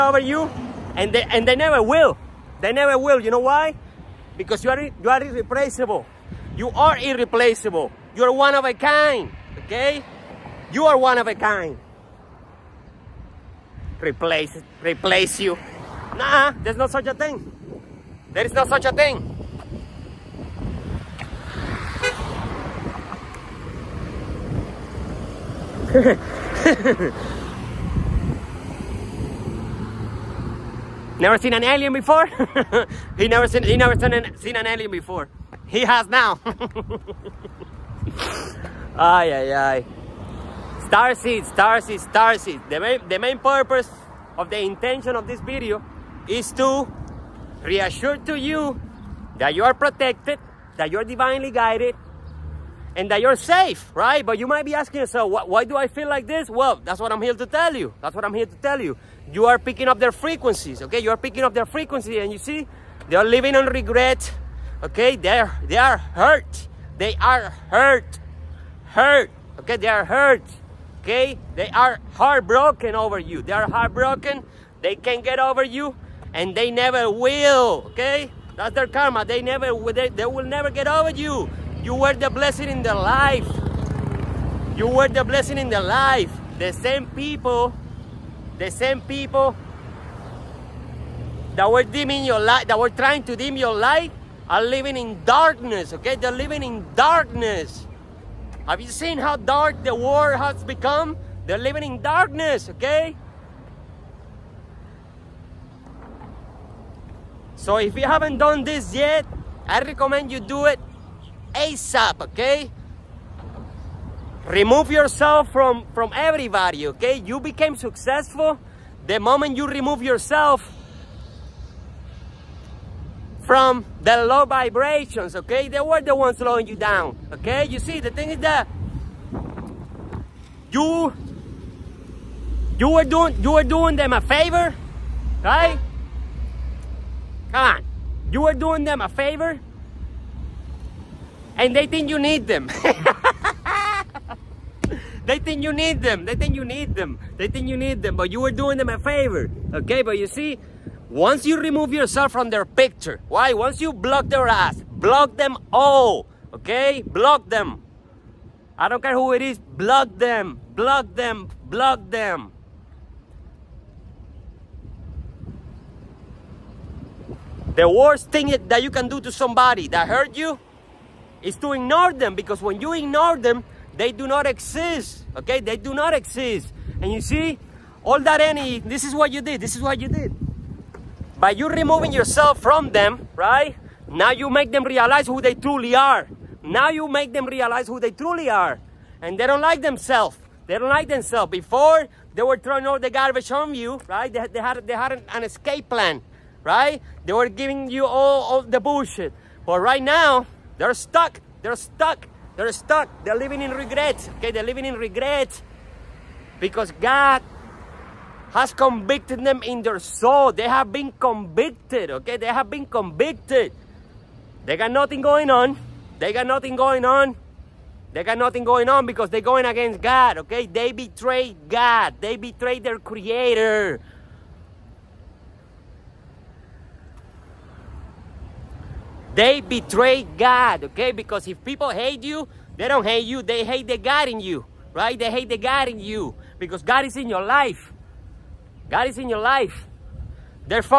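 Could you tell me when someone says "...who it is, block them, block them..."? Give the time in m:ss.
2:39.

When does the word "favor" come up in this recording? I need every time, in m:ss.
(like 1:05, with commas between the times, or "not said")
2:14, 2:19, 2:28.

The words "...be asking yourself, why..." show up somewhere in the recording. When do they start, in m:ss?
0:54.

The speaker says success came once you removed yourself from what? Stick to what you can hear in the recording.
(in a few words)
Low vibrations.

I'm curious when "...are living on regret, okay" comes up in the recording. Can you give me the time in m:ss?
1:03.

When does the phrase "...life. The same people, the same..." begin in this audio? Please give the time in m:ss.
1:25.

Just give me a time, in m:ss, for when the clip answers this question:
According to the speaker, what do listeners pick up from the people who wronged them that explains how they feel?
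0:59.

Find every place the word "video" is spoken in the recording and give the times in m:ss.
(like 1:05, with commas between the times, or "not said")
0:45.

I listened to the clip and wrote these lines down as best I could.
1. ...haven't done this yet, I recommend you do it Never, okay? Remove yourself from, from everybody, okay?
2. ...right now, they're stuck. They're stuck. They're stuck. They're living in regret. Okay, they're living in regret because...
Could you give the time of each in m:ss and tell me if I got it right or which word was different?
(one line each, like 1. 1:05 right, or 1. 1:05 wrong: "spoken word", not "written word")
1. 1:48 wrong: "ASAP", not "Never"
2. 3:19 right.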